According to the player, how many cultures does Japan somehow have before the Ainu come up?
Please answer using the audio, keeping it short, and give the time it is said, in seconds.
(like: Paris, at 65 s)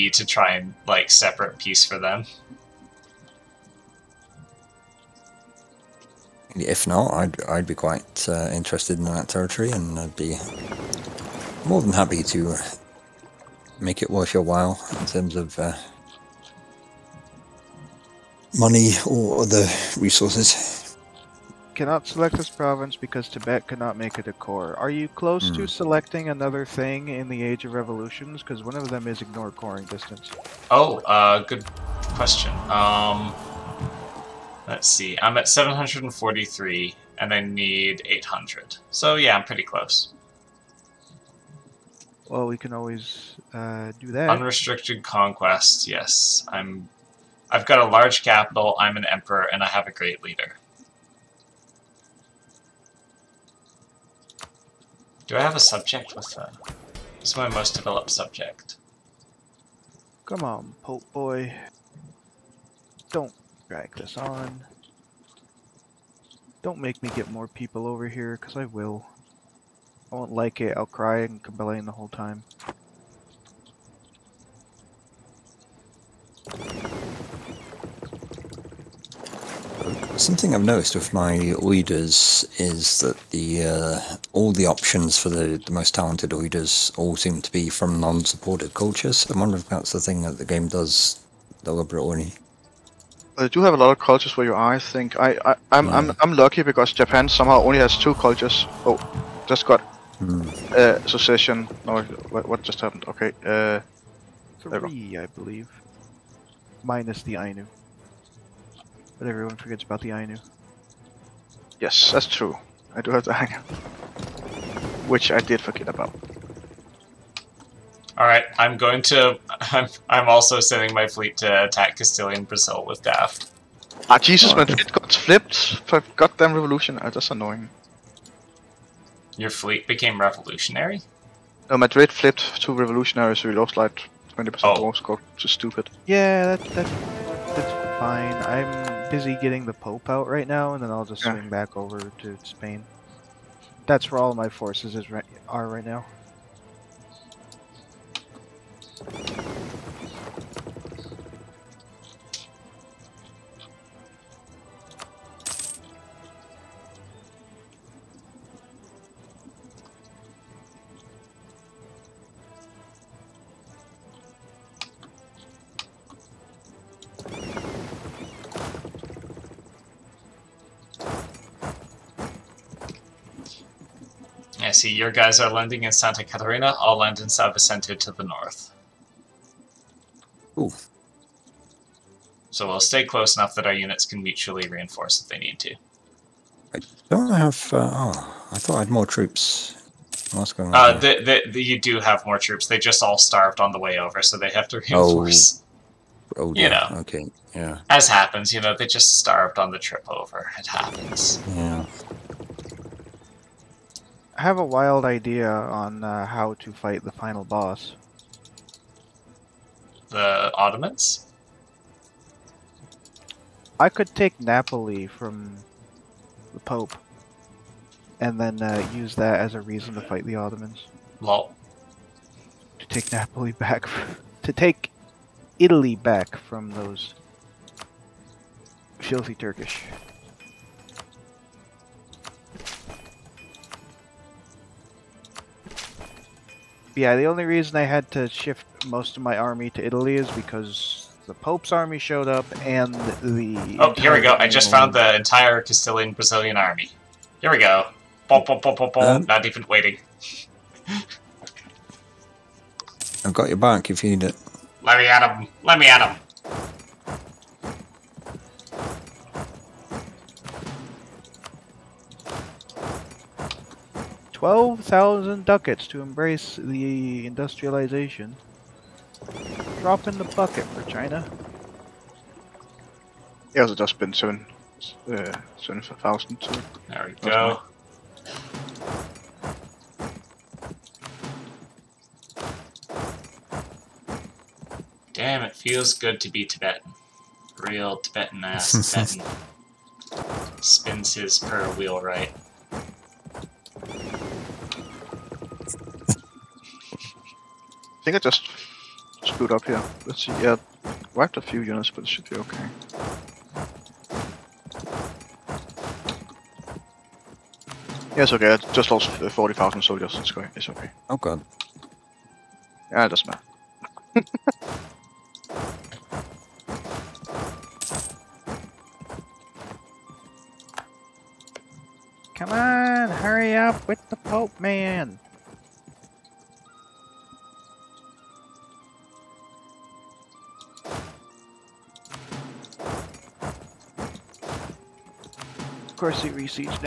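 2, at 97 s.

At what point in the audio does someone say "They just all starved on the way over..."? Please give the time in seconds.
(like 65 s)
192 s.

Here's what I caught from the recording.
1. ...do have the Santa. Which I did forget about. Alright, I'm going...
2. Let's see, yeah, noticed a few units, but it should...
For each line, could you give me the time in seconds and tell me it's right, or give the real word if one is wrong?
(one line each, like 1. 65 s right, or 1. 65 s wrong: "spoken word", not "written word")
1. 113 s wrong: "Ainu", not "Santa"
2. 300 s wrong: "wiped", not "noticed".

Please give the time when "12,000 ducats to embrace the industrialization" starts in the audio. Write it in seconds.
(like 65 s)
264 s.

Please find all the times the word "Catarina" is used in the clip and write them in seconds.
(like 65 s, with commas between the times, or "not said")
176 s.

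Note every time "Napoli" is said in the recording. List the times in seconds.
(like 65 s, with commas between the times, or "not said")
214 s, 223 s.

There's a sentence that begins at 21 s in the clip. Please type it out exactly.
Cannot select this province because Tibet cannot make it a core.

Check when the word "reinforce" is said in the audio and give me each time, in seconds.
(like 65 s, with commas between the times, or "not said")
184 s, 195 s.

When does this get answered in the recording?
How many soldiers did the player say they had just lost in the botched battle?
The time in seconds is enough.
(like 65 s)
309 s.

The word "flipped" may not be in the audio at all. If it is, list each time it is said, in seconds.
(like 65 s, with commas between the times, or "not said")
125 s, 132 s.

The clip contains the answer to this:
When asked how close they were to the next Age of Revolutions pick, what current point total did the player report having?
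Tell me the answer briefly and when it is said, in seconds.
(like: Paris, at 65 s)
743, at 35 s.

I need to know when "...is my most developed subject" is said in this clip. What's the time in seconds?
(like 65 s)
57 s.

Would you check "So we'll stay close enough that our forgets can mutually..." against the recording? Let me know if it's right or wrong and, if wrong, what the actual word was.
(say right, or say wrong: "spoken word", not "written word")
wrong: "units", not "forgets".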